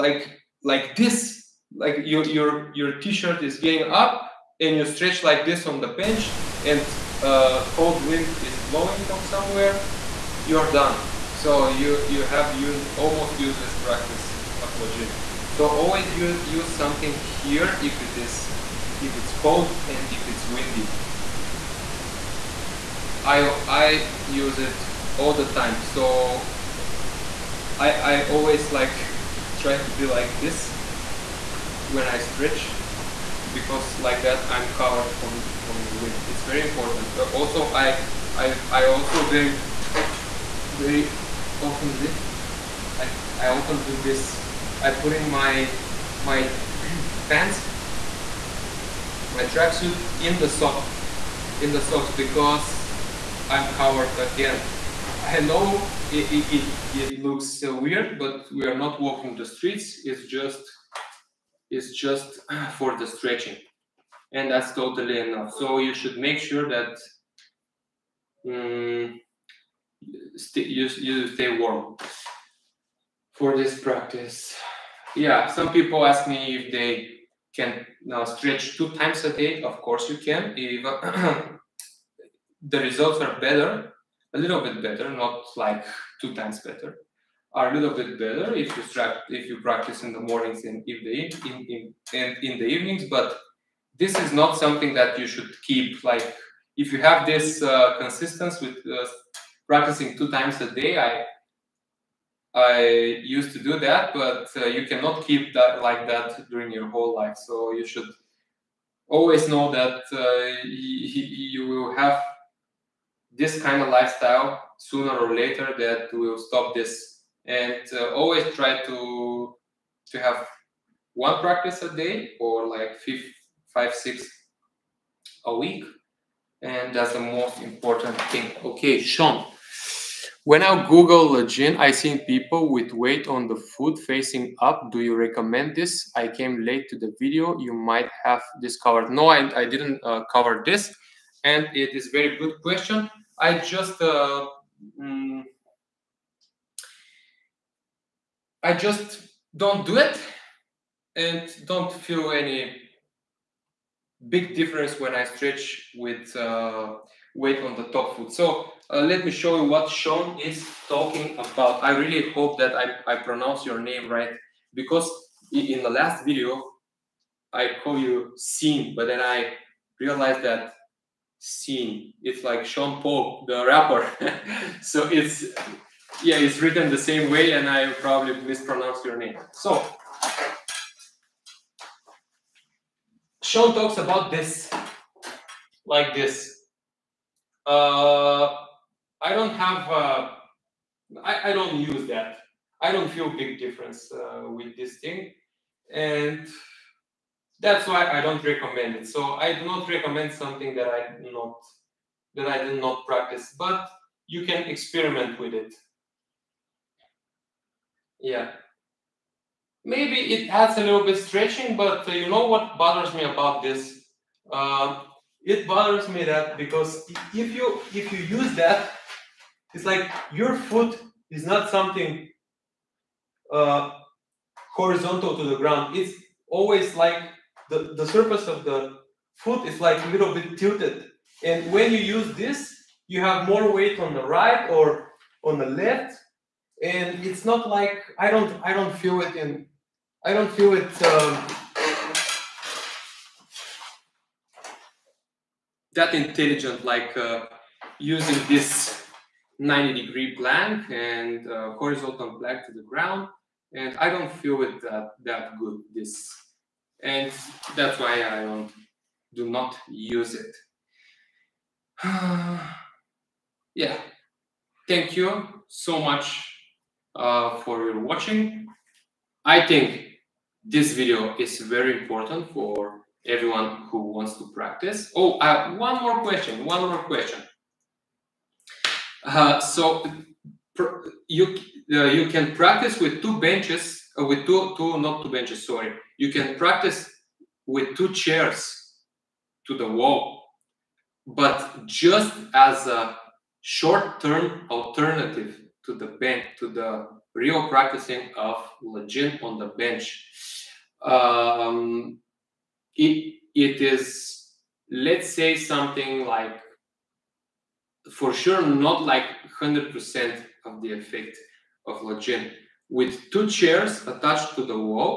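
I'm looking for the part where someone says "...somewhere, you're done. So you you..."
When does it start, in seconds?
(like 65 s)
9 s.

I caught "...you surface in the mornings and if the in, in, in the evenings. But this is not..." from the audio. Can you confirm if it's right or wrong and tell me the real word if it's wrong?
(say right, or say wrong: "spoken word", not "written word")
wrong: "practice", not "surface".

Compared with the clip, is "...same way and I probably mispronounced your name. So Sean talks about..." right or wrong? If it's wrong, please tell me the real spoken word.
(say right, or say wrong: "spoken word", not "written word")
right.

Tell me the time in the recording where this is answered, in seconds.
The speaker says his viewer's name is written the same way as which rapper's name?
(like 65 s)
172 s.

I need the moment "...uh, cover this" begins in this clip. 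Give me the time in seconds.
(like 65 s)
140 s.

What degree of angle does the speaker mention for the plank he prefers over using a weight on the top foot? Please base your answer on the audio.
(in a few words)
90.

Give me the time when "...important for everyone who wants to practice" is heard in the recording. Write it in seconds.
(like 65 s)
272 s.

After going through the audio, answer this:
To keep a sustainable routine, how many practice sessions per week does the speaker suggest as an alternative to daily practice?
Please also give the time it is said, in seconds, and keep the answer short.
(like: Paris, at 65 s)
5 or 6, at 123 s.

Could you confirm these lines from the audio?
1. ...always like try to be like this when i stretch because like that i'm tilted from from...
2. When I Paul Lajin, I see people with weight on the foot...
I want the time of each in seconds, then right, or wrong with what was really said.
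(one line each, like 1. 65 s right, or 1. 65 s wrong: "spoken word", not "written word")
1. 28 s wrong: "covered", not "tilted"
2. 130 s wrong: "Google", not "Paul".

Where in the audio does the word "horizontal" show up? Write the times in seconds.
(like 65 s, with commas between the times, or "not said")
224 s, 251 s.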